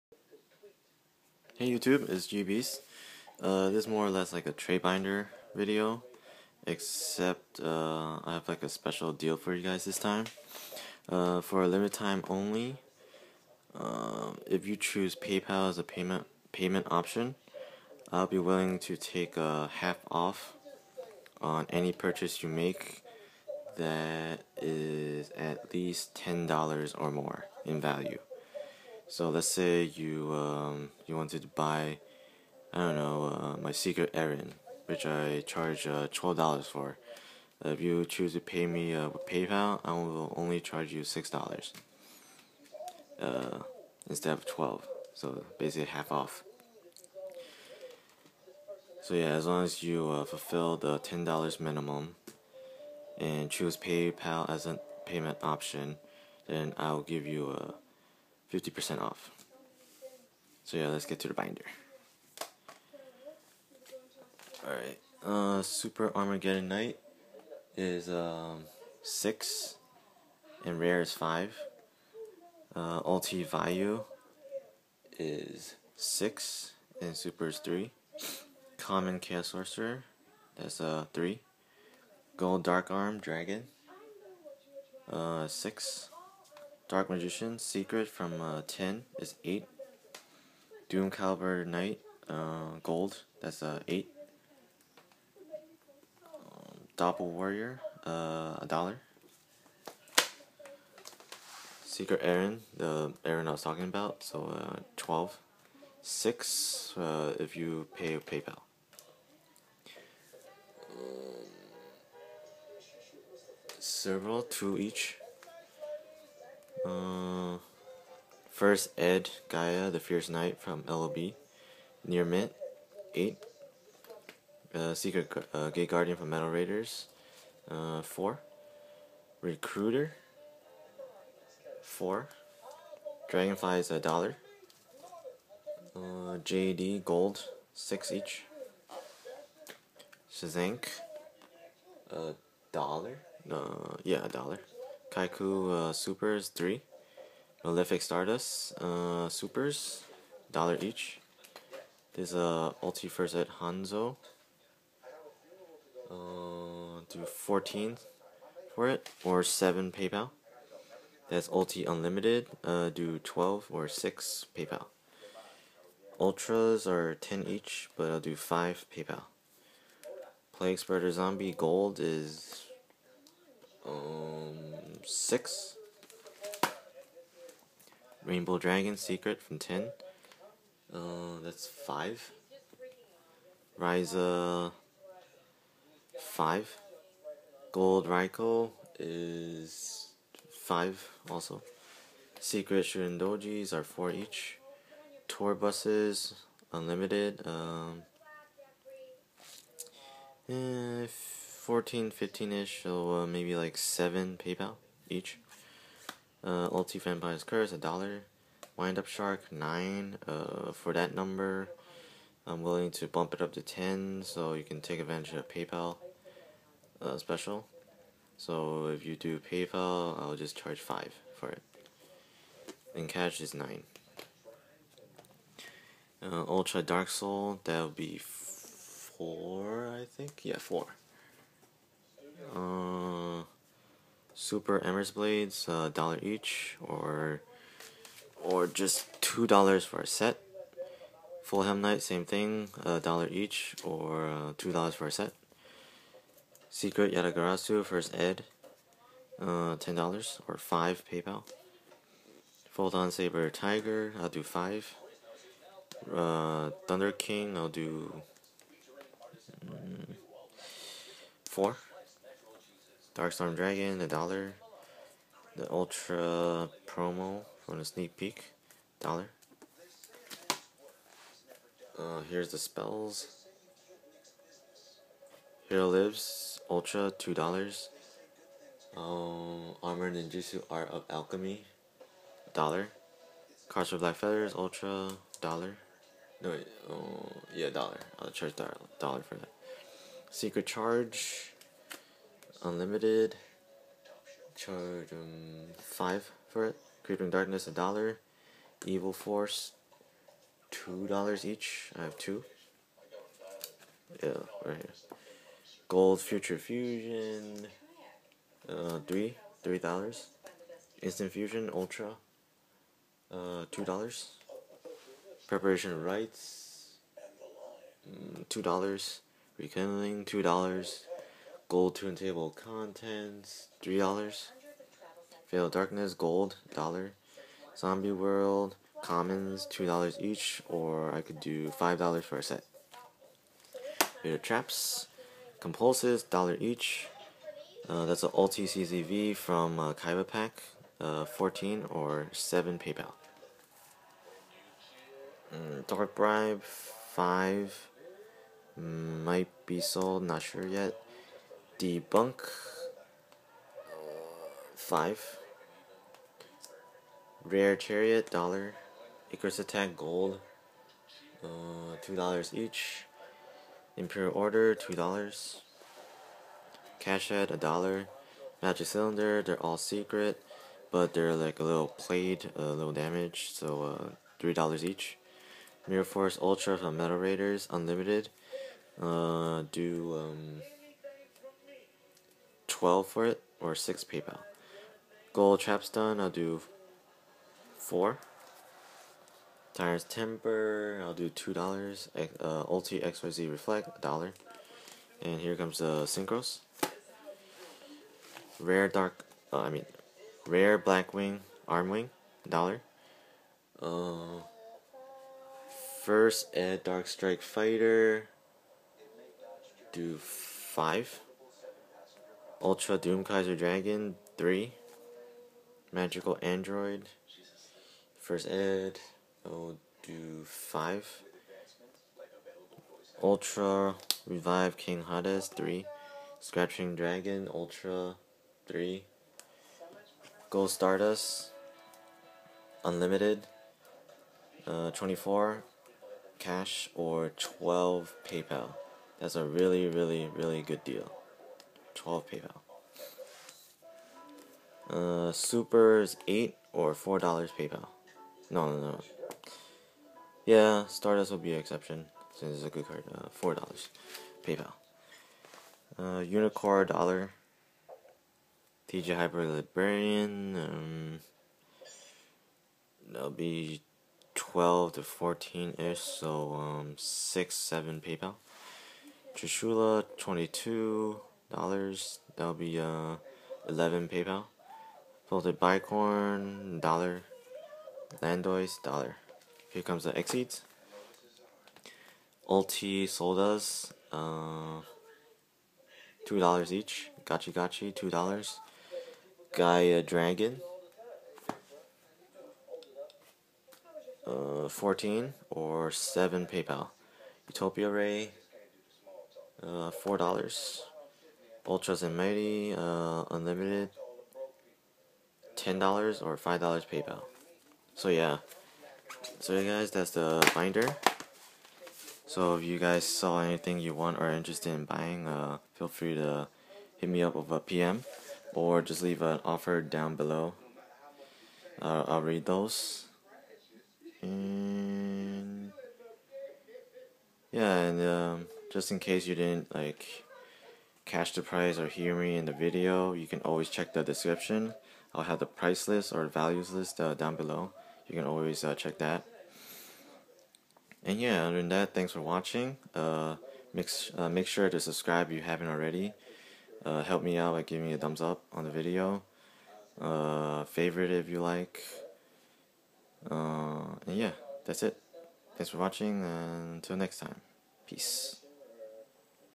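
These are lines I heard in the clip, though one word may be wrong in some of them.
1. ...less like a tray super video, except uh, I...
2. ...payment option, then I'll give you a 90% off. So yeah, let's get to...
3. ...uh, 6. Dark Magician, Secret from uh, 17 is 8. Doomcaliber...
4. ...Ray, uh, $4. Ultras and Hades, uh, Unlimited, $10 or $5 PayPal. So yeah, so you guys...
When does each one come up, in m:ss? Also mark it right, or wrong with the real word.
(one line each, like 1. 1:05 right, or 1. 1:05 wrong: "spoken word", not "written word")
1. 0:04 wrong: "binder", not "super"
2. 0:55 wrong: "50", not "90"
3. 1:25 wrong: "10", not "17"
4. 8:17 wrong: "Mighty", not "Hades".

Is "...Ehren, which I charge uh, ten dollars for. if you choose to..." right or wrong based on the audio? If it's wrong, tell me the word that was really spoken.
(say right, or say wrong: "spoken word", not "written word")
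wrong: "twelve", not "ten".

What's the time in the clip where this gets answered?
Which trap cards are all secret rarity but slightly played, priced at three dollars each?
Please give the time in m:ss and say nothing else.
6:08.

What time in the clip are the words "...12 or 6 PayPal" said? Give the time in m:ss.
2:43.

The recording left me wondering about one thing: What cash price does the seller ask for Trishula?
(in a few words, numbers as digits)
22 dollars.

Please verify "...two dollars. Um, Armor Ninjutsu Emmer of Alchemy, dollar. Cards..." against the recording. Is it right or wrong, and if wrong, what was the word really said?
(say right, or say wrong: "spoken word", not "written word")
wrong: "Art", not "Emmer".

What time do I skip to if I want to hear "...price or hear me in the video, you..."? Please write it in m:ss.
8:51.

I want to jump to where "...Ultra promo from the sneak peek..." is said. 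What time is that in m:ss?
4:25.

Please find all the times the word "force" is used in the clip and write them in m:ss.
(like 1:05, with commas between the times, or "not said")
4:59, 6:16.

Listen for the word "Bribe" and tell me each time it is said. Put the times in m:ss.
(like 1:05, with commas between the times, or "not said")
5:46.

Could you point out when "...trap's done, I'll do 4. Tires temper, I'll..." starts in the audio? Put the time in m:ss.
6:25.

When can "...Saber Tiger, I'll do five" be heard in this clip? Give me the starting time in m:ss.
4:13.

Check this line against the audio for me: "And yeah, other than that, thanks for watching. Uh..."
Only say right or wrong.
right.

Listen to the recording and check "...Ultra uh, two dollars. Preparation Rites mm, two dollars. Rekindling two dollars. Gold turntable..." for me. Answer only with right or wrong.
right.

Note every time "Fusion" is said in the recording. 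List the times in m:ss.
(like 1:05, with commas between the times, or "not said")
5:06, 5:11.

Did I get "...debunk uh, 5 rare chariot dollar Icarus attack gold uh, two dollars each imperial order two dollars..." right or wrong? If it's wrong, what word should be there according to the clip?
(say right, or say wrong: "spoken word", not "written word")
right.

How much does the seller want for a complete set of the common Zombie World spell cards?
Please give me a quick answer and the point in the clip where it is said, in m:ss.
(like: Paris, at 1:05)
five dollars, at 5:31.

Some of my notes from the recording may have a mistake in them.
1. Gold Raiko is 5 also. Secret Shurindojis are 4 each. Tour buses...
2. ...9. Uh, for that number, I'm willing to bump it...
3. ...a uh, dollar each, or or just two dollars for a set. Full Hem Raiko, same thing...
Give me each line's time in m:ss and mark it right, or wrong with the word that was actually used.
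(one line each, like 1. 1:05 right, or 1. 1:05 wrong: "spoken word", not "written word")
1. 3:07 right
2. 3:29 right
3. 3:55 wrong: "Knight", not "Raiko".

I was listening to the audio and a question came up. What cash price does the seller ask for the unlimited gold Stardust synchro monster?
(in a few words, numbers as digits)
24.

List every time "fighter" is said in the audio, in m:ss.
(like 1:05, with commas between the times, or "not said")
6:47.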